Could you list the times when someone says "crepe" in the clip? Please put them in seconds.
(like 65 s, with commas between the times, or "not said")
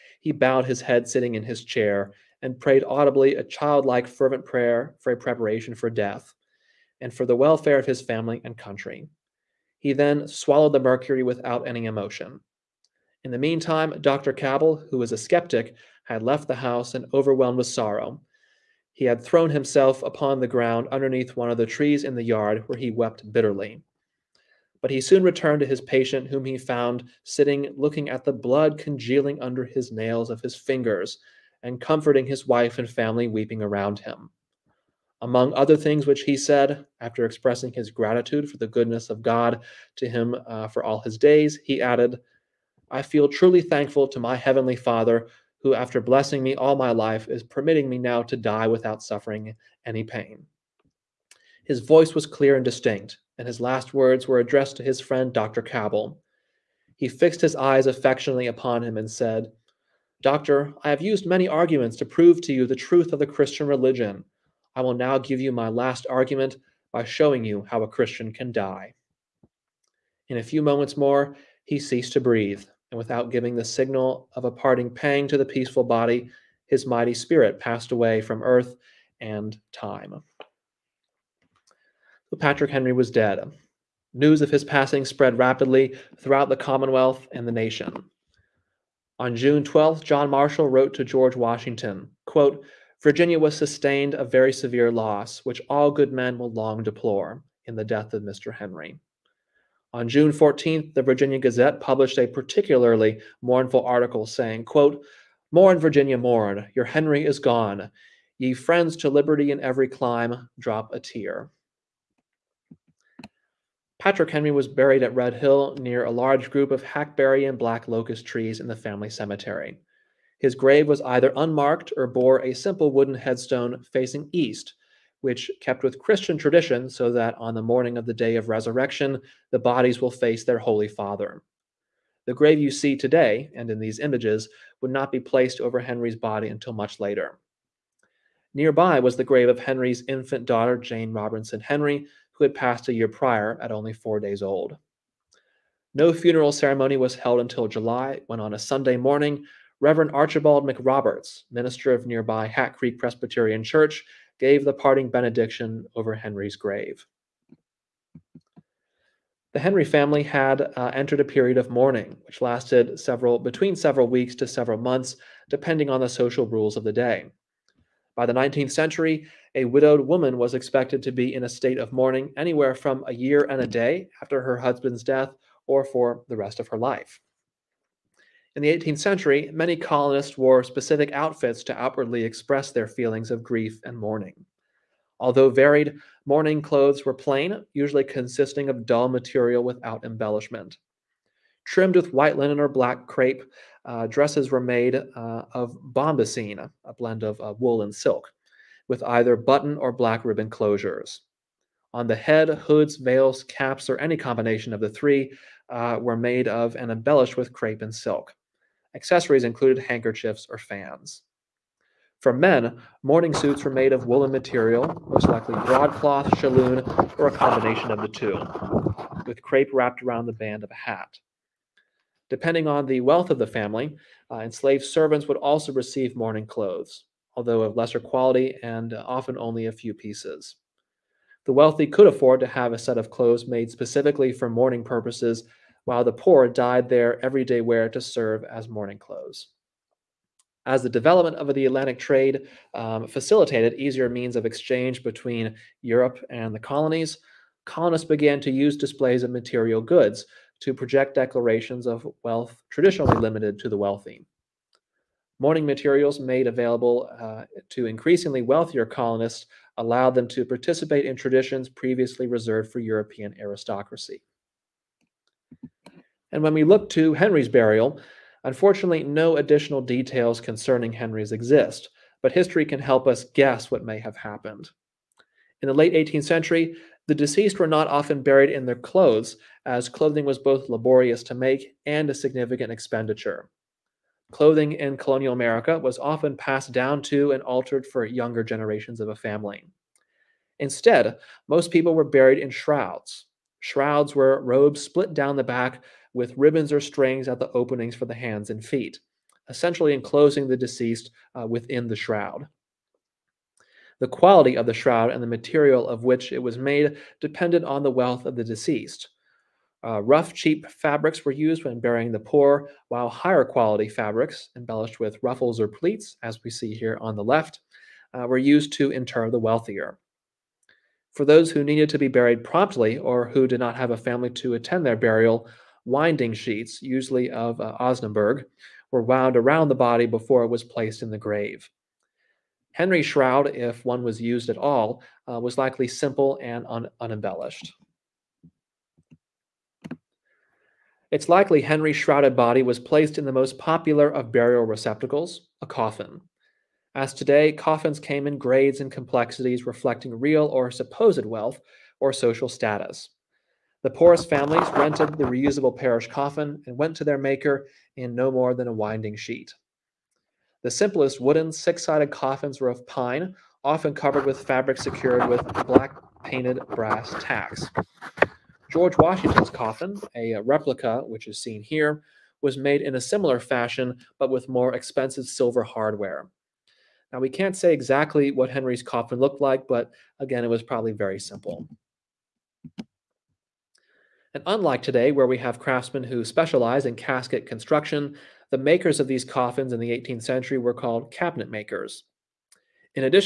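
193 s, 207 s, 219 s.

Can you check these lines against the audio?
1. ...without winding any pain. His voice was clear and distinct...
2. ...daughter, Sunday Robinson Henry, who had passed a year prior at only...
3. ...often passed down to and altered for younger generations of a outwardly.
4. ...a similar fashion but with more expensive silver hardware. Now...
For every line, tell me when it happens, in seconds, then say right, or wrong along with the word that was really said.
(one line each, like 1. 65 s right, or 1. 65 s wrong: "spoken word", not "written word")
1. 48 s wrong: "suffering", not "winding"
2. 140 s wrong: "Jane", not "Sunday"
3. 285 s wrong: "family", not "outwardly"
4. 372 s right.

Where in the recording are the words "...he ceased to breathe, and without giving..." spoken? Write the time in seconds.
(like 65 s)
71 s.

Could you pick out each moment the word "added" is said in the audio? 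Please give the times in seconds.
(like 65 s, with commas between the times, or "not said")
41 s.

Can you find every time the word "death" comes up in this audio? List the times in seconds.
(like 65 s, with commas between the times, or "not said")
5 s, 97 s, 175 s.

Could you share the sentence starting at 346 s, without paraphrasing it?
As today, coffins came in grades and complexities reflecting real or supposed wealth or social status.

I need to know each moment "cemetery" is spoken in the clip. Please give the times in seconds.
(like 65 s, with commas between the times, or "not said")
119 s.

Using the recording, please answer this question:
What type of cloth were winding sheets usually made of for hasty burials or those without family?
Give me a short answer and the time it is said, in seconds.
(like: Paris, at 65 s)
Osnaburg, at 327 s.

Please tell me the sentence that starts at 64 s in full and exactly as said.
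I will now give you my last argument by showing you how a Christian can die.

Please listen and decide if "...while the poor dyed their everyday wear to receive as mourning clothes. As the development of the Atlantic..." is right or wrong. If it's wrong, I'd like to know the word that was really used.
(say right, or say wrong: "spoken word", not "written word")
wrong: "serve", not "receive".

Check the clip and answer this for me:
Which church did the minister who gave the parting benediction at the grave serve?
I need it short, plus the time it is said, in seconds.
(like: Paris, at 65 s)
Hat Creek Presbyterian Church, at 152 s.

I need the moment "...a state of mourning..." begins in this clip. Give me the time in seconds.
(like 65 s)
171 s.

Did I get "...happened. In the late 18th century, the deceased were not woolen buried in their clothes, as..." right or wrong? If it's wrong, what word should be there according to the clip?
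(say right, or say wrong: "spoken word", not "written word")
wrong: "often", not "woolen".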